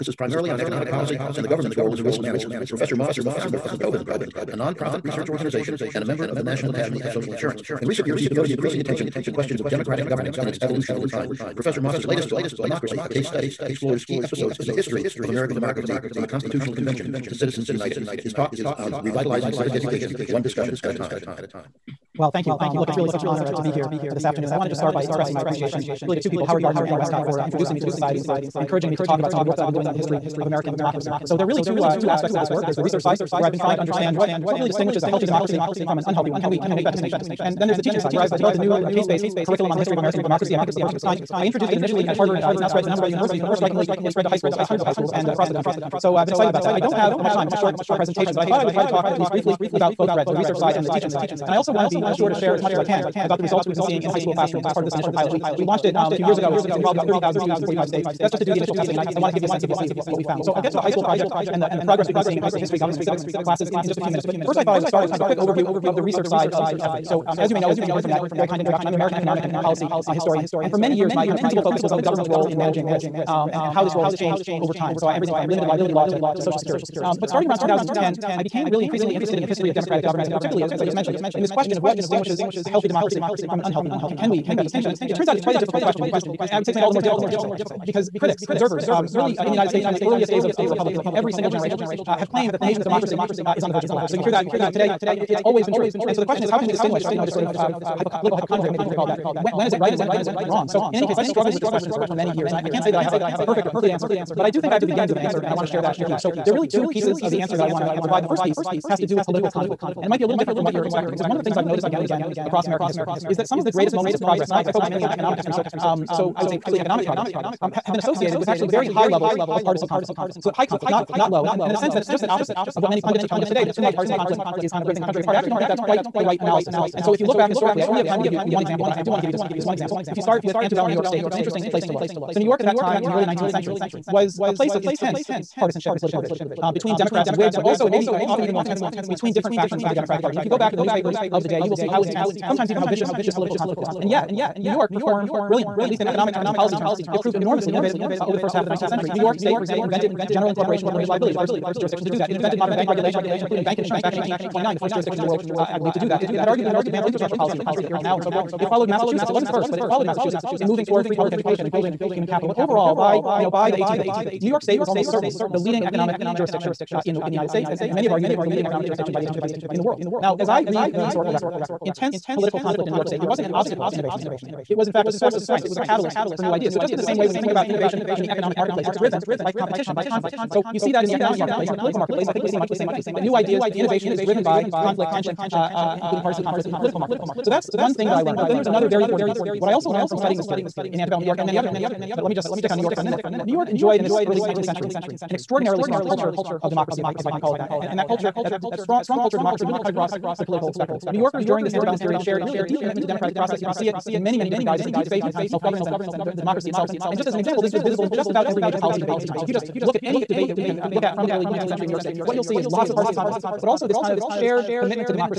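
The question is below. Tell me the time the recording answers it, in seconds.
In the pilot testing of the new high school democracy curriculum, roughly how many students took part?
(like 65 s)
57 s.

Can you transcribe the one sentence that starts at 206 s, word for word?
And and just as an example, this was visible in just about every major policy debate of the time.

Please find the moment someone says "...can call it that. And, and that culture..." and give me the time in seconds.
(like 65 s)
197 s.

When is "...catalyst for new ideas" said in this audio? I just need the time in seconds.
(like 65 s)
175 s.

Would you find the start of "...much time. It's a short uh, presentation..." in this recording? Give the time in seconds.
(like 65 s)
47 s.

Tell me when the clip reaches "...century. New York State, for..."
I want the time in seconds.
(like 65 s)
148 s.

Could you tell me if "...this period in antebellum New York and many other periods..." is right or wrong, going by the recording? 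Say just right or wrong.
right.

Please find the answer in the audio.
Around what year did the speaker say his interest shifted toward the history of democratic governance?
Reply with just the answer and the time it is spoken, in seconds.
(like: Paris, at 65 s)
2010, at 77 s.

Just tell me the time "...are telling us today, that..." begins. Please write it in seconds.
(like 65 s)
123 s.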